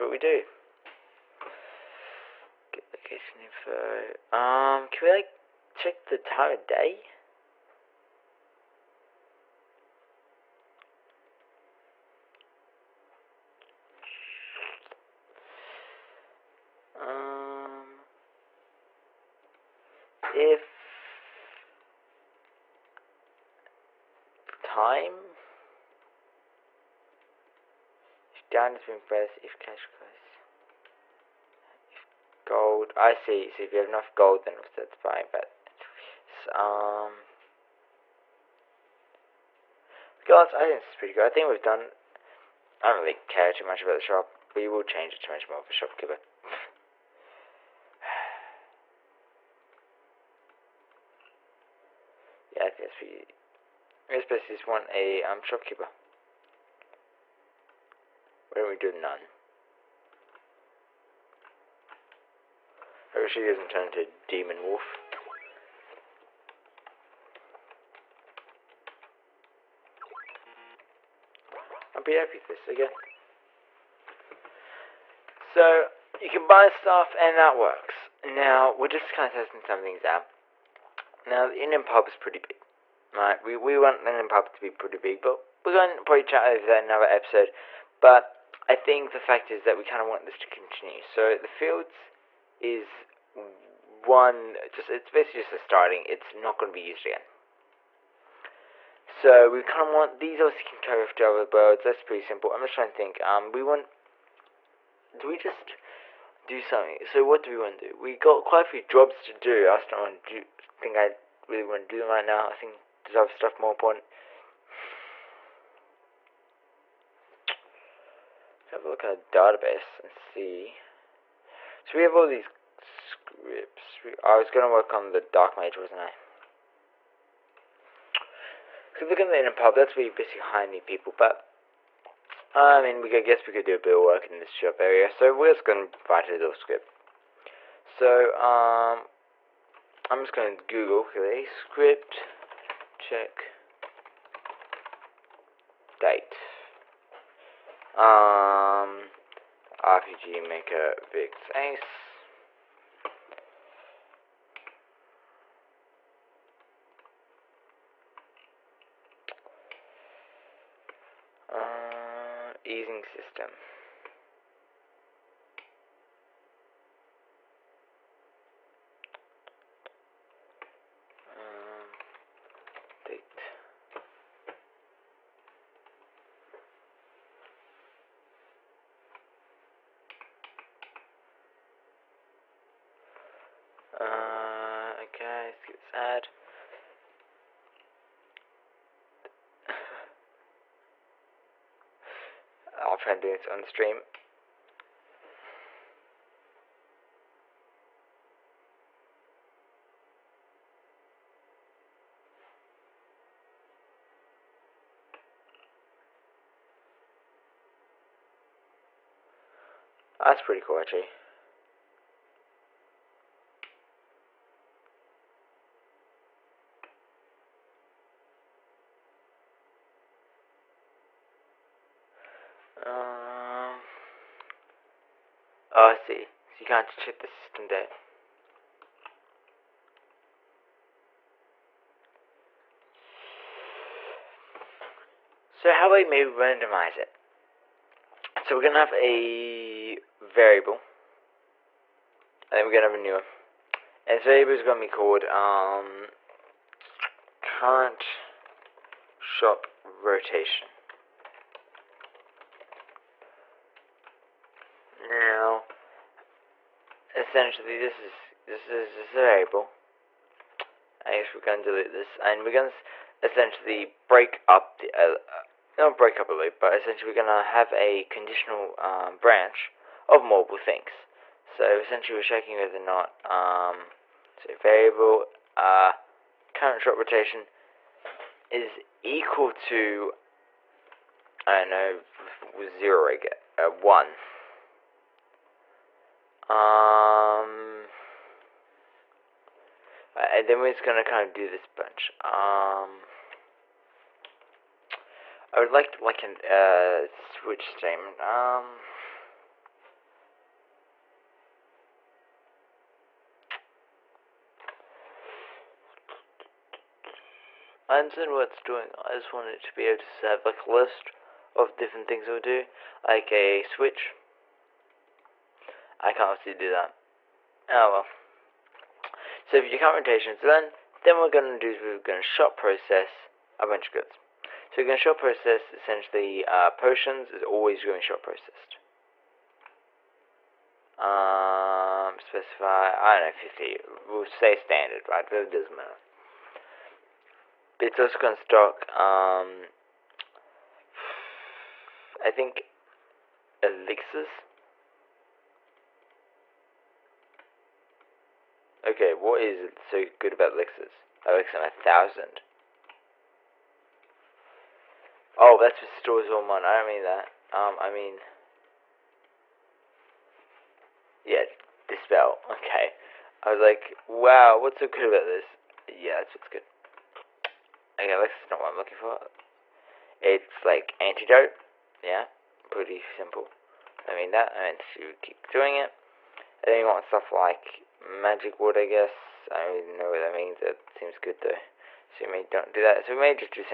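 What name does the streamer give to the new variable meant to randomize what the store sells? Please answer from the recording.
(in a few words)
current shop rotation.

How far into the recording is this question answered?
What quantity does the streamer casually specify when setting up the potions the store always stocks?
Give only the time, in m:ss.
5:33.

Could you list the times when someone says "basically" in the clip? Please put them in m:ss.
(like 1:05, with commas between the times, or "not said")
1:35, 2:10.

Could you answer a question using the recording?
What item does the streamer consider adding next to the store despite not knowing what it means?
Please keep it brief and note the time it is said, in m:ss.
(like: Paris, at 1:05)
magic wood, at 6:17.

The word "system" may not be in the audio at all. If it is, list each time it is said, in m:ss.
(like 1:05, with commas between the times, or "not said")
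2:43, 3:47.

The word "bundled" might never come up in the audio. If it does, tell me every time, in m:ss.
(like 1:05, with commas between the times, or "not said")
not said.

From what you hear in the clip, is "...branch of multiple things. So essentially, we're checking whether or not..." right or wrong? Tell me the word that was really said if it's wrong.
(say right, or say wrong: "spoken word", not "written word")
right.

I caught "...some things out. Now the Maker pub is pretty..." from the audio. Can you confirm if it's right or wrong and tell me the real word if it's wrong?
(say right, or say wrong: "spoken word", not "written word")
wrong: "Indian", not "Maker".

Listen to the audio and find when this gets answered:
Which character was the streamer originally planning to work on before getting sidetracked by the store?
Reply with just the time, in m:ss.
2:05.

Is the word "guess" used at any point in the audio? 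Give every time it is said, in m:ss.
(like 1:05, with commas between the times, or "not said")
0:54, 2:13, 4:21, 6:18.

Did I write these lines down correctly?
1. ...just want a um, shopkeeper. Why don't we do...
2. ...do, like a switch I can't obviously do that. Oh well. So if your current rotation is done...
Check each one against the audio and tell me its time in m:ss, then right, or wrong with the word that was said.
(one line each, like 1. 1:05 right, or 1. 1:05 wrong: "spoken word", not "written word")
1. 0:54 right
2. 5:12 right.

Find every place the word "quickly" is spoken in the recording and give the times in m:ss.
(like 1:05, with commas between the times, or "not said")
2:21.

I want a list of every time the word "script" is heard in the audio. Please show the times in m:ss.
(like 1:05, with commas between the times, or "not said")
2:02, 2:16, 2:21.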